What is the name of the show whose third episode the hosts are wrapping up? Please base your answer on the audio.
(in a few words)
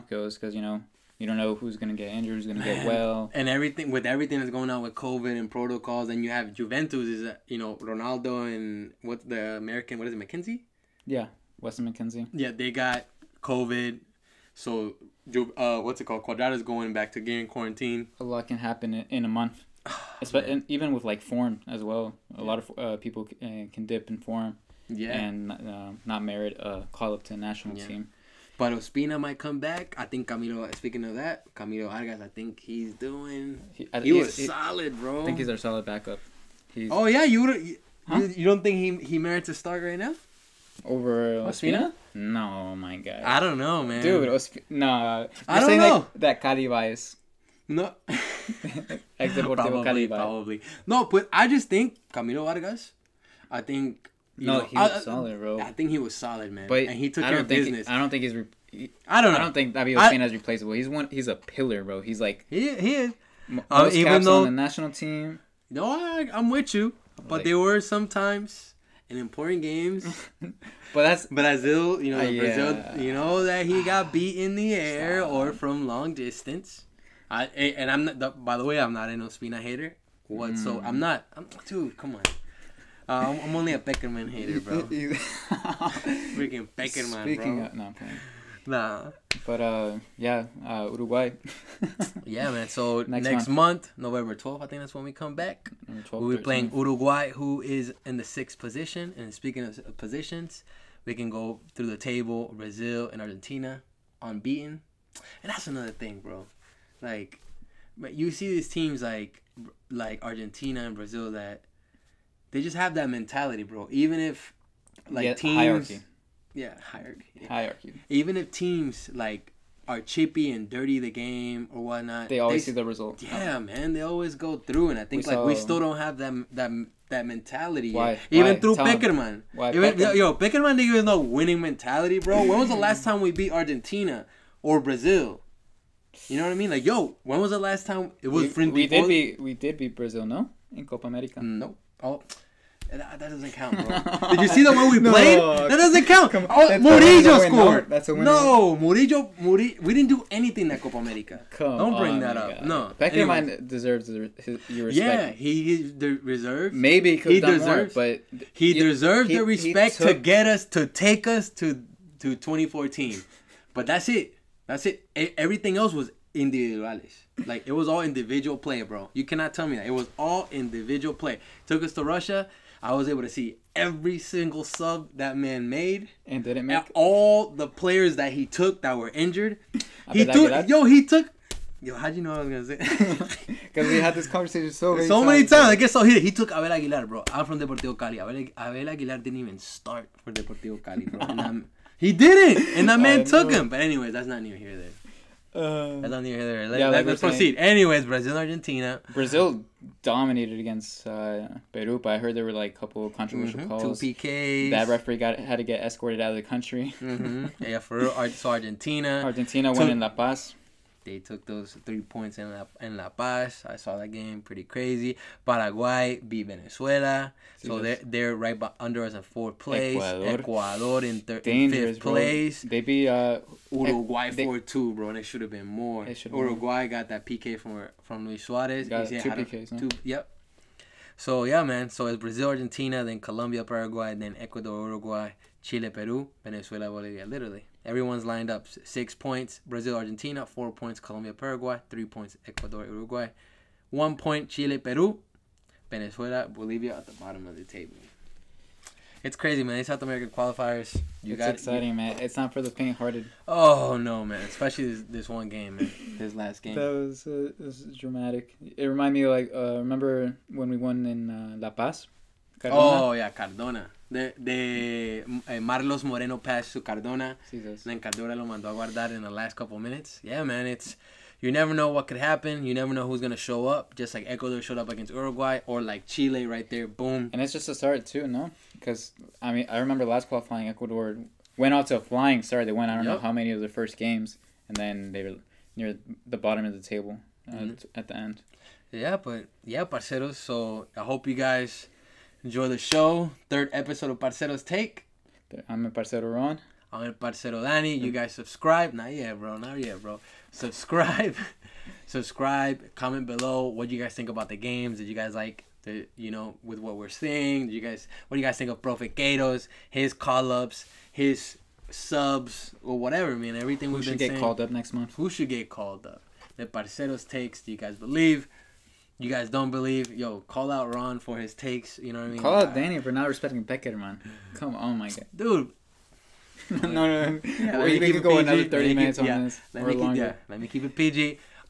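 Parceros Take.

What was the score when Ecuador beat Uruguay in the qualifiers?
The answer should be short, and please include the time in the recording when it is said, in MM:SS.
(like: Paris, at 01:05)
4-2, at 03:44.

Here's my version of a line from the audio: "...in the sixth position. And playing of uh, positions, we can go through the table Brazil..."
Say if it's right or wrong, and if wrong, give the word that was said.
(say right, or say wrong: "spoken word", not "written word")
wrong: "speaking", not "playing".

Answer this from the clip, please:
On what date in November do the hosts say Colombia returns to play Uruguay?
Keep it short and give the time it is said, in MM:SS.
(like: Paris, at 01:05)
November 12, at 01:33.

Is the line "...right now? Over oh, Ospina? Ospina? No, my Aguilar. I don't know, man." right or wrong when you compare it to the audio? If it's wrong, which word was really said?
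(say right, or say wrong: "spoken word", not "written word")
wrong: "God", not "Aguilar".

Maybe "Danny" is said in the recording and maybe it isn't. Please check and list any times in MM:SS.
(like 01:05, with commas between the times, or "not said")
04:57, 05:22.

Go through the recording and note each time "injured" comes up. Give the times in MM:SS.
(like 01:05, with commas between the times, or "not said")
00:02, 02:59.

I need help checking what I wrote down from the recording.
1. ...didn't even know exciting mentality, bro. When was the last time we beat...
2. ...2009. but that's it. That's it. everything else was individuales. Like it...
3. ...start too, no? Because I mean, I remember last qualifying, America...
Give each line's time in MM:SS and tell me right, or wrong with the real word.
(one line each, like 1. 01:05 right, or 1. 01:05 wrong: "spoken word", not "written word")
1. 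02:10 wrong: "winning", not "exciting"
2. 02:42 wrong: "2014", not "2009"
3. 04:37 wrong: "Ecuador", not "America".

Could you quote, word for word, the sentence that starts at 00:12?
Yeah, they got COVID, so uh, what's it called?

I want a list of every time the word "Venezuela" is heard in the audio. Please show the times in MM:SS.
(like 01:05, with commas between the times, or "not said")
03:36, 03:56, 04:05.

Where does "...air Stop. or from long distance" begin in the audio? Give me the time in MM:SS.
01:14.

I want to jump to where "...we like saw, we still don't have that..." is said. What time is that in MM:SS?
02:05.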